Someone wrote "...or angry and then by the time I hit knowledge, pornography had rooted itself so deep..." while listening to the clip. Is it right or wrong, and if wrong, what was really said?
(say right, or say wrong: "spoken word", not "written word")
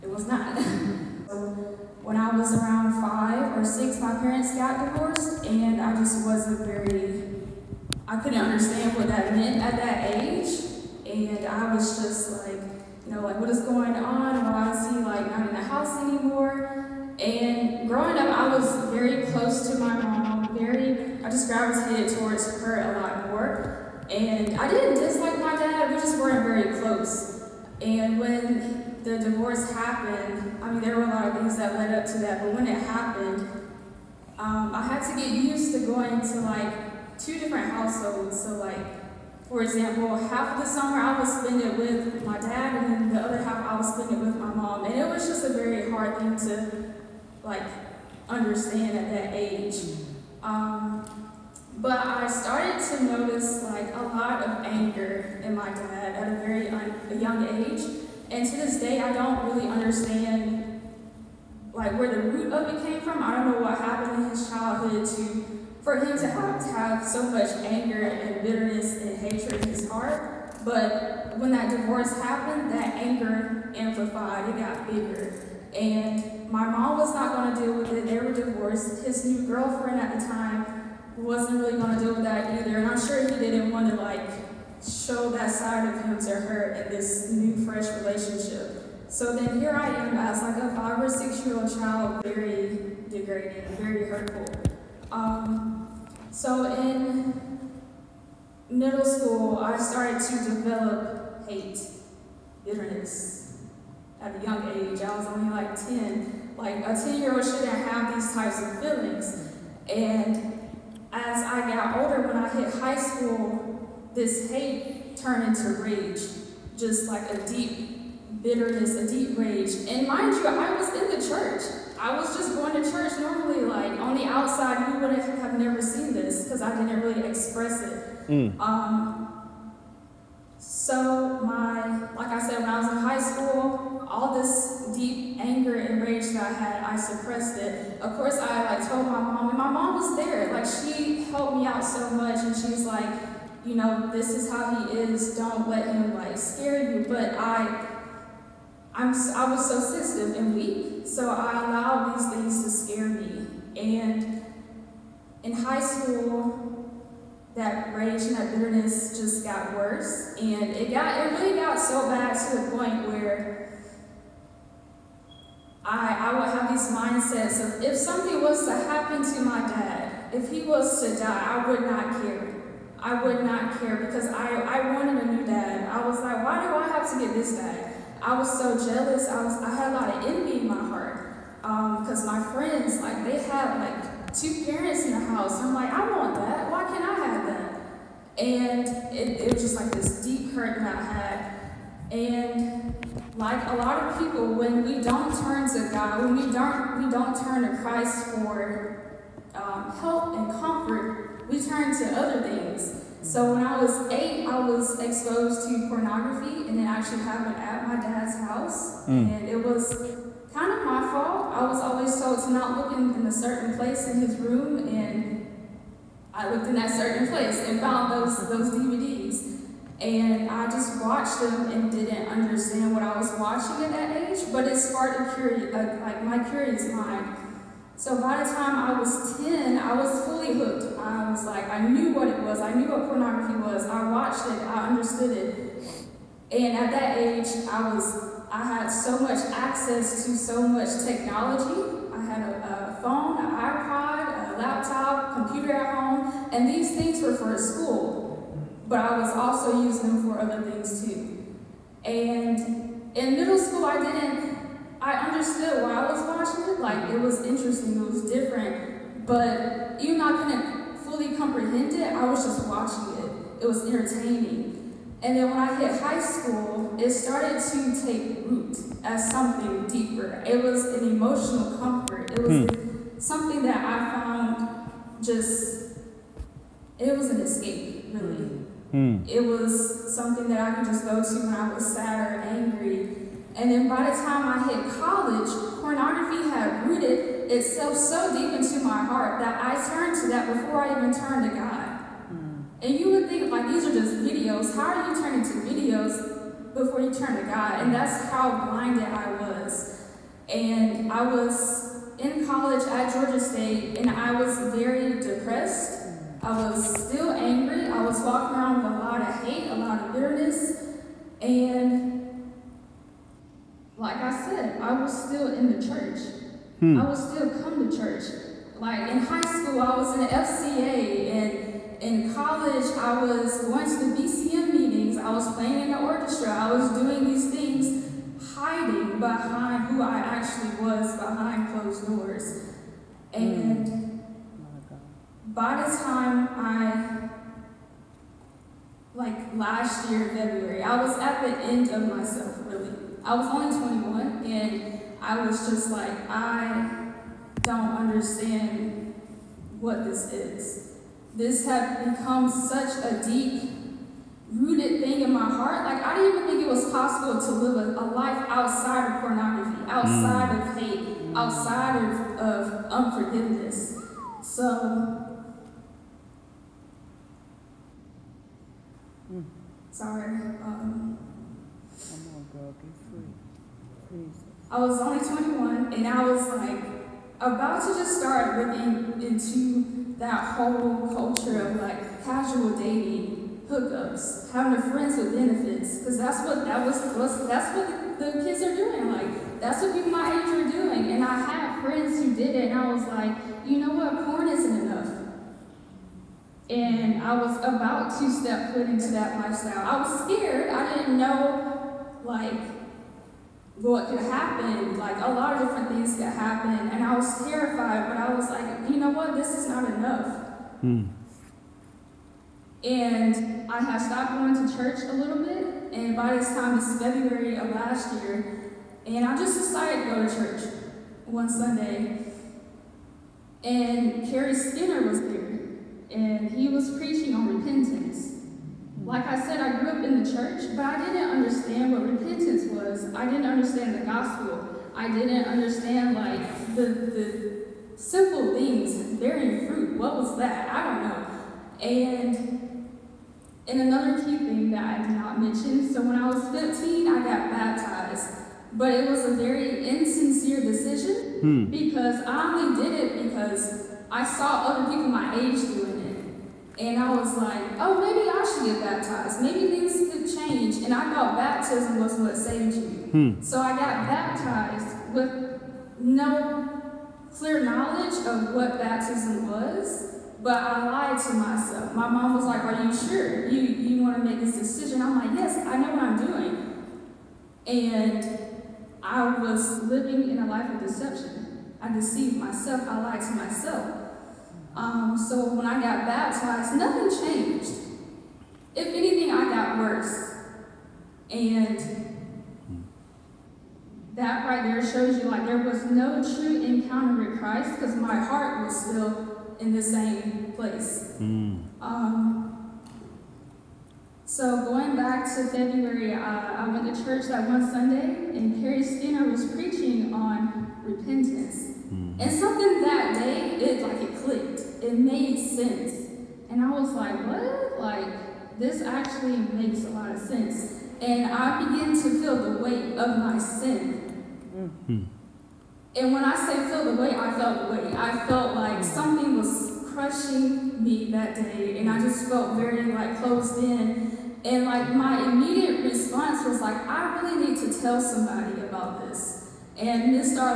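wrong: "college", not "knowledge".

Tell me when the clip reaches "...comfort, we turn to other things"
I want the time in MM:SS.
03:20.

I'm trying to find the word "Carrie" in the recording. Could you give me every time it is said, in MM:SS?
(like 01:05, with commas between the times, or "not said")
07:04, 08:28.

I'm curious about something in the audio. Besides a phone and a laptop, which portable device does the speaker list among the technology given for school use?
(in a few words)
iPod.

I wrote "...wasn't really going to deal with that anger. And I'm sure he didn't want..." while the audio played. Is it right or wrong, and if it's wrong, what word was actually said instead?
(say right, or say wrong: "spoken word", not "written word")
wrong: "either", not "anger".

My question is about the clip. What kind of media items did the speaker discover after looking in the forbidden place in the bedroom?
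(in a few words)
DVDs.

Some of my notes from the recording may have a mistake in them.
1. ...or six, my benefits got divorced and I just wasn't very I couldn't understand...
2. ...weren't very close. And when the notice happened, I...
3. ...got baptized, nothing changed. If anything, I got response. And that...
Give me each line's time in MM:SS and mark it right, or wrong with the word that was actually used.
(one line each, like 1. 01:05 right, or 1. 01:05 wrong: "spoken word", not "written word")
1. 00:03 wrong: "parents", not "benefits"
2. 00:26 wrong: "divorce", not "notice"
3. 08:05 wrong: "worse", not "response".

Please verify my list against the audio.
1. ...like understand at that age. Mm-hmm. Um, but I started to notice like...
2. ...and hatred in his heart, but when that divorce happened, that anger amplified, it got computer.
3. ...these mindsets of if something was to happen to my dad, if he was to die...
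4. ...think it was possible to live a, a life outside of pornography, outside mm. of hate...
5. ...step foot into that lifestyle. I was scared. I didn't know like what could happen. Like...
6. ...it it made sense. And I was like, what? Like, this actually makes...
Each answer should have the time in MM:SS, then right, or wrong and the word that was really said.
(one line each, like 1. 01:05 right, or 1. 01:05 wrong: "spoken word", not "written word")
1. 00:47 right
2. 01:09 wrong: "bigger", not "computer"
3. 02:46 right
4. 05:56 right
5. 06:38 right
6. 08:34 right.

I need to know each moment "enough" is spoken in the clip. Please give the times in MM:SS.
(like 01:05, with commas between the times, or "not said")
06:34, 06:49.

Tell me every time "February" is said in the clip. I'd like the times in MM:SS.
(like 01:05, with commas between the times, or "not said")
05:40, 06:57, 08:25.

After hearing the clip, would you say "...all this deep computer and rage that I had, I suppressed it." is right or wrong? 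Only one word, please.
wrong.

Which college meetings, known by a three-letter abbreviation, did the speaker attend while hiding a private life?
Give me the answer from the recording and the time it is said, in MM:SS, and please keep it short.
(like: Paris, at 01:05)
BCM meetings, at 05:24.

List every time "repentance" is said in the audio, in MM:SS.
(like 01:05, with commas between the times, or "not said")
07:07, 07:12, 08:30.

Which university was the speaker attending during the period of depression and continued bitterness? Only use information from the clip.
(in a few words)
Georgia State.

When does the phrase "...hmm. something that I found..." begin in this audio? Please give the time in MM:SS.
04:32.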